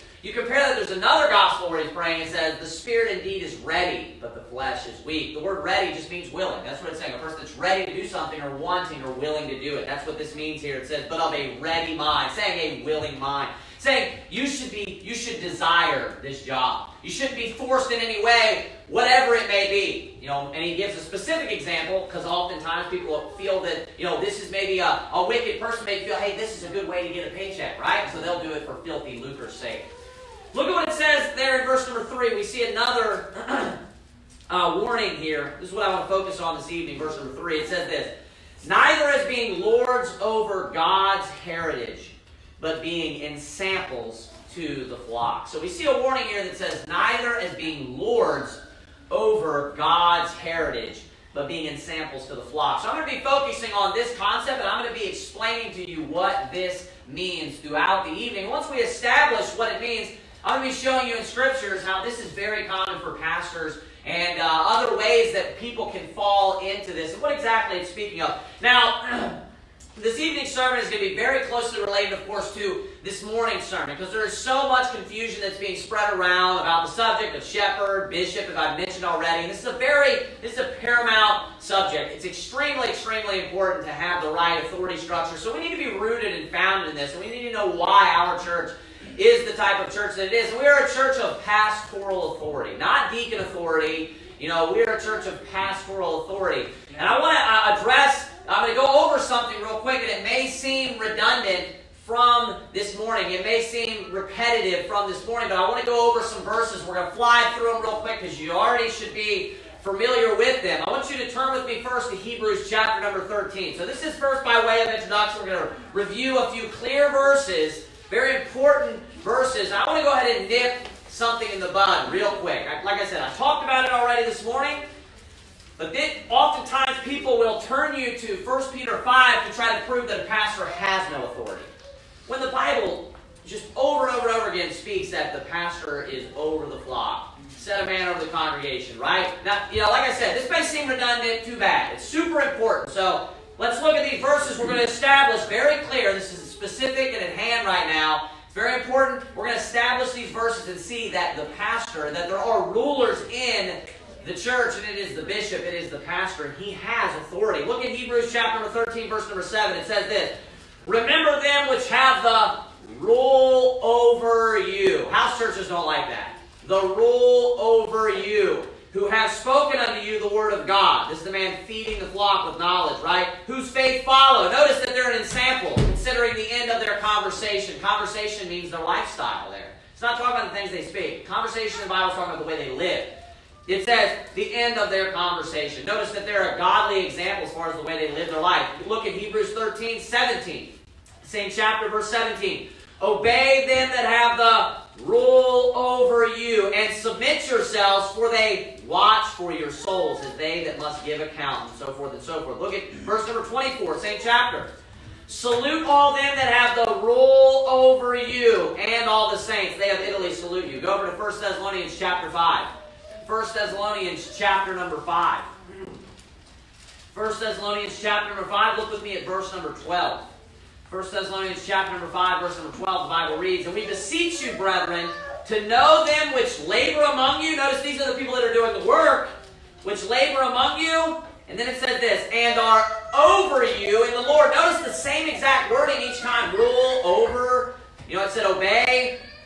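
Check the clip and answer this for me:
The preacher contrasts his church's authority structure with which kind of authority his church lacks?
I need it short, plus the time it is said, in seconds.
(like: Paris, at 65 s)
deacon authority, at 92 s.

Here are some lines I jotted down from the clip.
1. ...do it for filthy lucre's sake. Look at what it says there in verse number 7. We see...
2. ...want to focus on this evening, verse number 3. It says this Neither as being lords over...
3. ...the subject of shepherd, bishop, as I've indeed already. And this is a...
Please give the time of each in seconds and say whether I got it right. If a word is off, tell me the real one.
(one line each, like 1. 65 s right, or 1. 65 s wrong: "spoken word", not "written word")
1. 28 s wrong: "3", not "7"
2. 35 s right
3. 76 s wrong: "mentioned", not "indeed".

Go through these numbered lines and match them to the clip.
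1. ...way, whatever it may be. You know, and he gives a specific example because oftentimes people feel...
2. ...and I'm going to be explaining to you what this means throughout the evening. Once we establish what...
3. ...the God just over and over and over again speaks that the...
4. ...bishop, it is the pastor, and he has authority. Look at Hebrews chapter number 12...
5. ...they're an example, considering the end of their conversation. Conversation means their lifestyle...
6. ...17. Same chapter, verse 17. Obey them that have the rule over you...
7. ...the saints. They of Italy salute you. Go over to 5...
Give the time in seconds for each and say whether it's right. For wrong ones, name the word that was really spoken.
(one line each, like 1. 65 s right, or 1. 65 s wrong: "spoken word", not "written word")
1. 18 s right
2. 54 s right
3. 132 s wrong: "Bible", not "God"
4. 155 s wrong: "13", not "12"
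5. 174 s right
6. 189 s right
7. 209 s wrong: "1", not "5".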